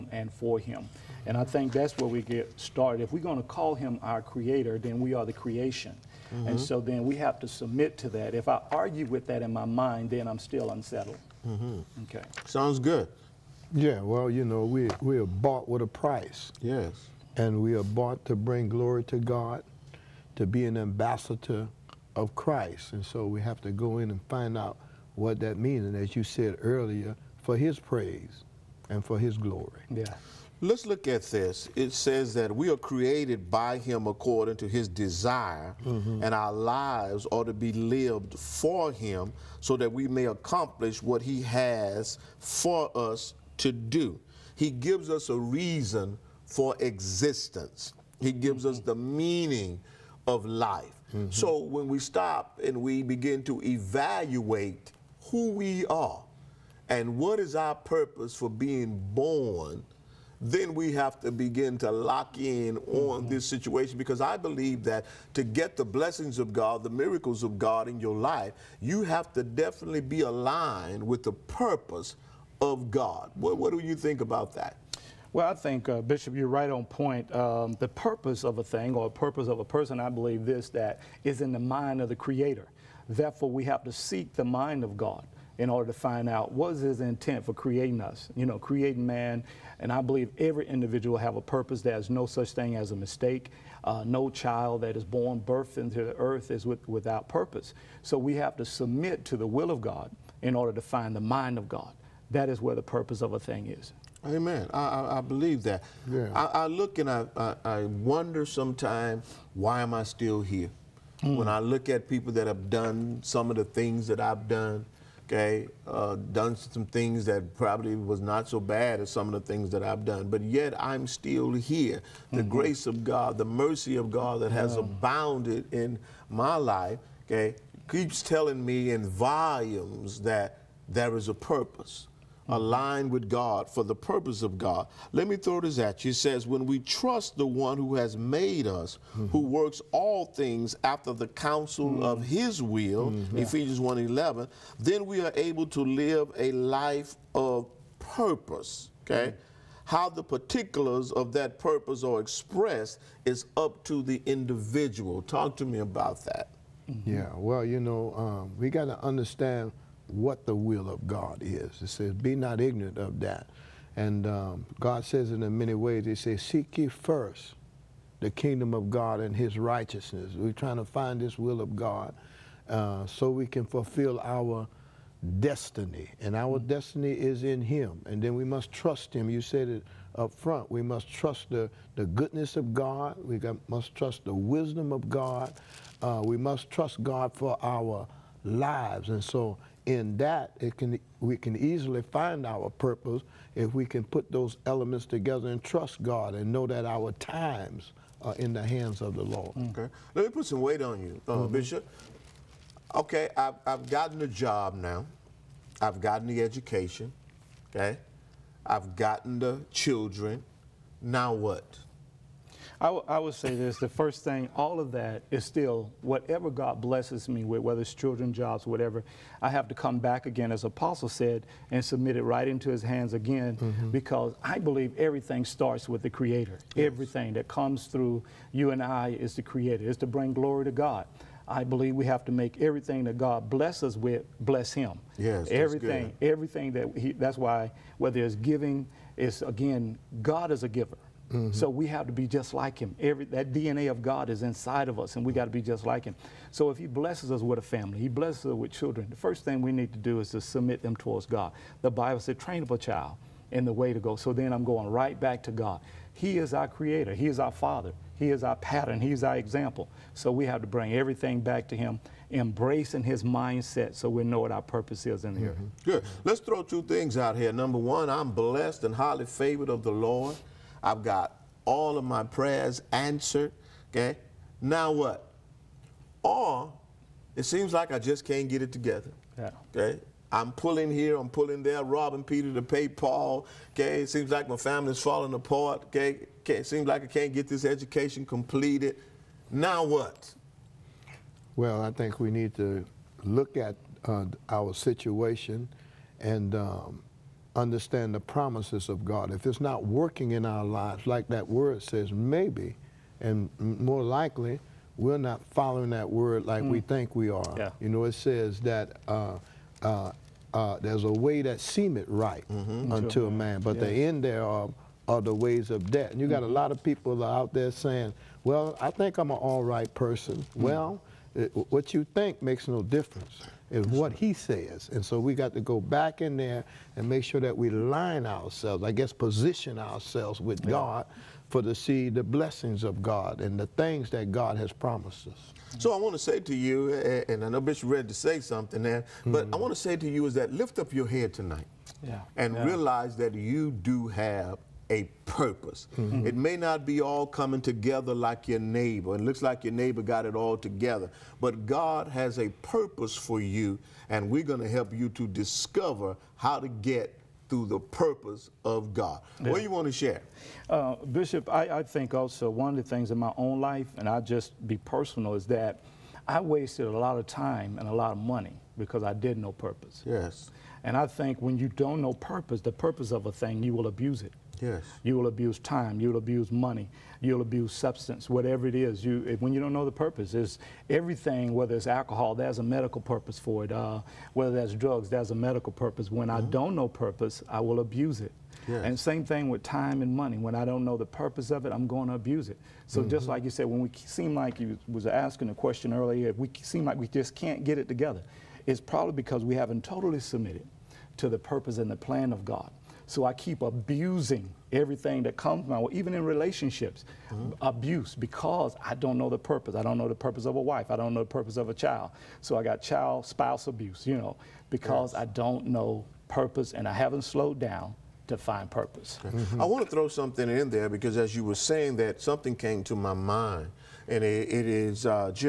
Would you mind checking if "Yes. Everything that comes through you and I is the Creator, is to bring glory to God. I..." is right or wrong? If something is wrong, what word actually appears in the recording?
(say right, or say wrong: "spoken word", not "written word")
right.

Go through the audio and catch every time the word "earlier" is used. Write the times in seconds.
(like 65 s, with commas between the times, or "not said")
26 s, 395 s.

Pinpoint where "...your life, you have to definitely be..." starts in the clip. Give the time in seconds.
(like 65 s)
67 s.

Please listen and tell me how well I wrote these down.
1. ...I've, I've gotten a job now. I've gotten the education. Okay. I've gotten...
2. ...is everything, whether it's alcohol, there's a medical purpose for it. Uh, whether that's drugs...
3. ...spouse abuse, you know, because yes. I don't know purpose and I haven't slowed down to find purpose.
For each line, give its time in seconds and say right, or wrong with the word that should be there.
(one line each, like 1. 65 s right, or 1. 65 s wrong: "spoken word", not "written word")
1. 203 s right
2. 380 s right
3. 413 s right.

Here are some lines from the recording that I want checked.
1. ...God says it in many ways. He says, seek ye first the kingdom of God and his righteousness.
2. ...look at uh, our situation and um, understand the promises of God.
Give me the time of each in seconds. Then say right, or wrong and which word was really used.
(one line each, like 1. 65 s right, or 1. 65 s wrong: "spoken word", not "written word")
1. 164 s right
2. 293 s right.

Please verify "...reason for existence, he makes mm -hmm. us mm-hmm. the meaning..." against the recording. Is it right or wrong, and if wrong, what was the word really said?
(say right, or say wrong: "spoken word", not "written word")
wrong: "gives", not "makes".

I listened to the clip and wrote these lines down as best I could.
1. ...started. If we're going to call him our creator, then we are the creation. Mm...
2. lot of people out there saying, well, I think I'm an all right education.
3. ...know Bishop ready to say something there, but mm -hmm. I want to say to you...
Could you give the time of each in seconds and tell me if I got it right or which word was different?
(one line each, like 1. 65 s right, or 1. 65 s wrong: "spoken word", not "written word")
1. 2 s right
2. 316 s wrong: "person", not "education"
3. 337 s right.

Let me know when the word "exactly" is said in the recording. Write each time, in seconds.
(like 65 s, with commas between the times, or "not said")
not said.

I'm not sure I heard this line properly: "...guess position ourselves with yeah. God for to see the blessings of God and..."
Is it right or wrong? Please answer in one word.
right.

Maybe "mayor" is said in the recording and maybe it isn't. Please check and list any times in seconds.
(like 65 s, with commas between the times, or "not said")
not said.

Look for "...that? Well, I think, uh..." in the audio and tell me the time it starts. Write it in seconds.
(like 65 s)
74 s.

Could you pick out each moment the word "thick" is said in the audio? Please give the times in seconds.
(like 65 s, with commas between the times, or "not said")
not said.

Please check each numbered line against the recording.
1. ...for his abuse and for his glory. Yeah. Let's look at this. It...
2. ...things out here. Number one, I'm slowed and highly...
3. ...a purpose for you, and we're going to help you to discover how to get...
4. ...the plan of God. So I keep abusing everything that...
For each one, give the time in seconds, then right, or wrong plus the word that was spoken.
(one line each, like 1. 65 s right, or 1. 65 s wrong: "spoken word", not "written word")
1. 27 s wrong: "praise", not "abuse"
2. 266 s wrong: "blessed", not "slowed"
3. 352 s right
4. 401 s right.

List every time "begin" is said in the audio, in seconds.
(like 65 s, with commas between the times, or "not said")
53 s, 61 s.